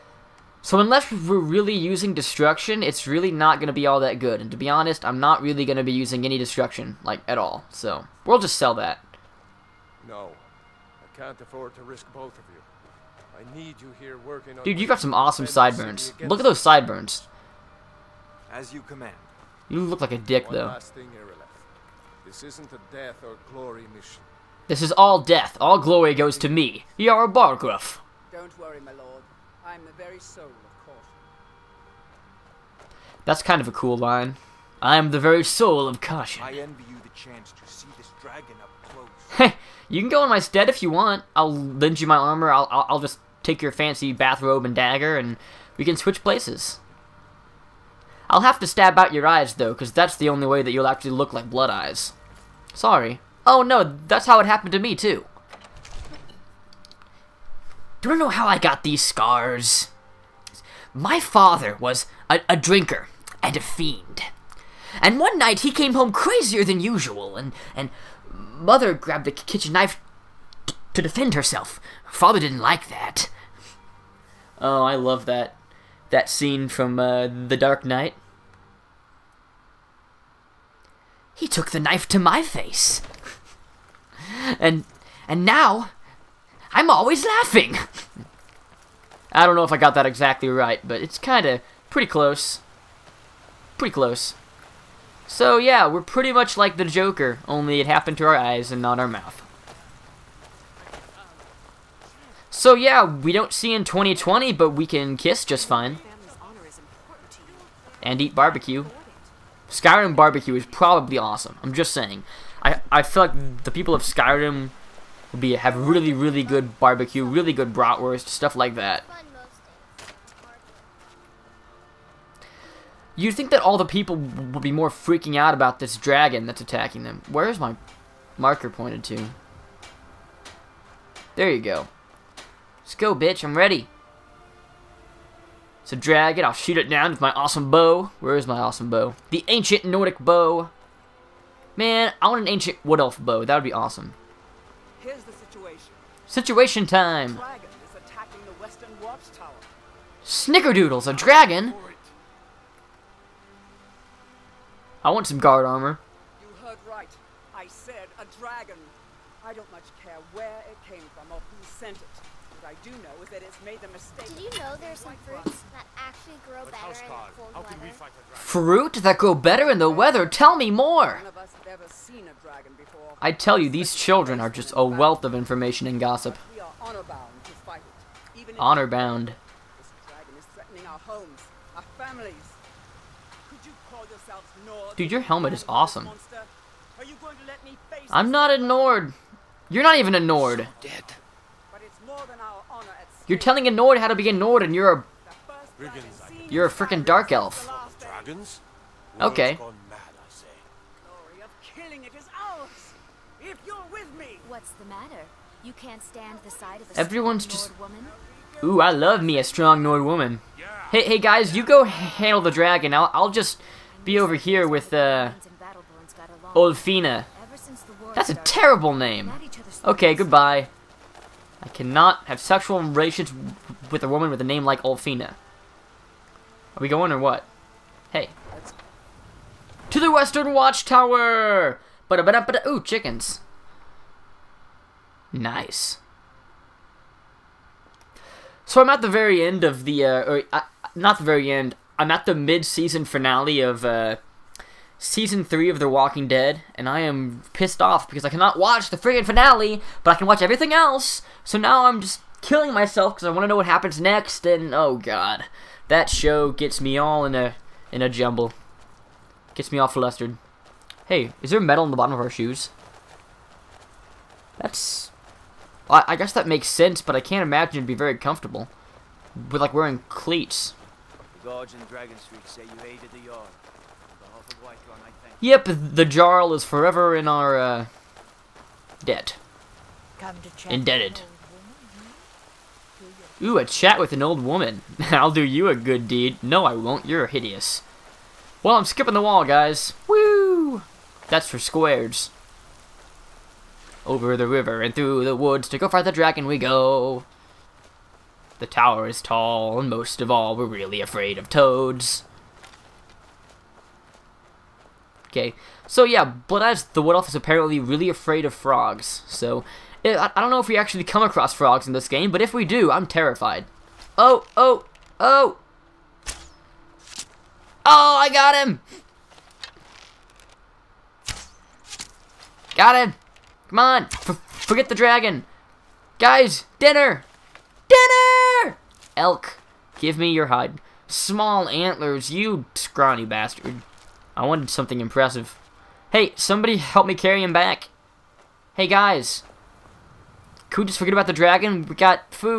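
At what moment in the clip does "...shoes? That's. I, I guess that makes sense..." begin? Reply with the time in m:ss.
4:22.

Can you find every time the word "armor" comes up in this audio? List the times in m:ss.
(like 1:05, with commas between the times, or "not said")
0:42, 2:35.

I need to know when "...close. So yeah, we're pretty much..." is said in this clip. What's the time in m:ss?
1:33.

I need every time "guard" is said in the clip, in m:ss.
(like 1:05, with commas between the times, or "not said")
2:35.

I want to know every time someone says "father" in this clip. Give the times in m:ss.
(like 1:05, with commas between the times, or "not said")
1:01, 1:12.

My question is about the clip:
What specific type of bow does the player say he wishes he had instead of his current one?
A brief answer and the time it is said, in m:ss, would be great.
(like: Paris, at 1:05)
Ancient wood elf bow, at 2:22.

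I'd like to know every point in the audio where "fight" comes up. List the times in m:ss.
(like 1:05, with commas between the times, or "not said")
2:57, 4:55.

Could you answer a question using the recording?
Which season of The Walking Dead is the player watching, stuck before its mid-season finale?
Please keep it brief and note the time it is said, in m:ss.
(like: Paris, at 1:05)
3, at 4:04.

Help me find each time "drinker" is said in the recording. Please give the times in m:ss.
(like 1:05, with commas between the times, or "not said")
1:02.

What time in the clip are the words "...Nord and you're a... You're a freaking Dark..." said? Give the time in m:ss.
3:14.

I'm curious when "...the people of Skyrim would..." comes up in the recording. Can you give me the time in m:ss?
1:53.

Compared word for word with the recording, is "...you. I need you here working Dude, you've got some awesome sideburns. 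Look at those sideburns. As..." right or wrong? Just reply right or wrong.
right.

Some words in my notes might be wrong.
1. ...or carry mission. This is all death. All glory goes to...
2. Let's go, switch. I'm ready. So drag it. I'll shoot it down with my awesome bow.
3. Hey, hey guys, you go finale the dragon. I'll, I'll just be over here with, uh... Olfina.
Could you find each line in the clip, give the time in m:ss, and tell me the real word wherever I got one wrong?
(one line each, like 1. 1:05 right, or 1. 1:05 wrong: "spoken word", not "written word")
1. 0:23 wrong: "glory", not "carry"
2. 2:12 wrong: "bitch", not "switch"
3. 3:30 wrong: "handle", not "finale".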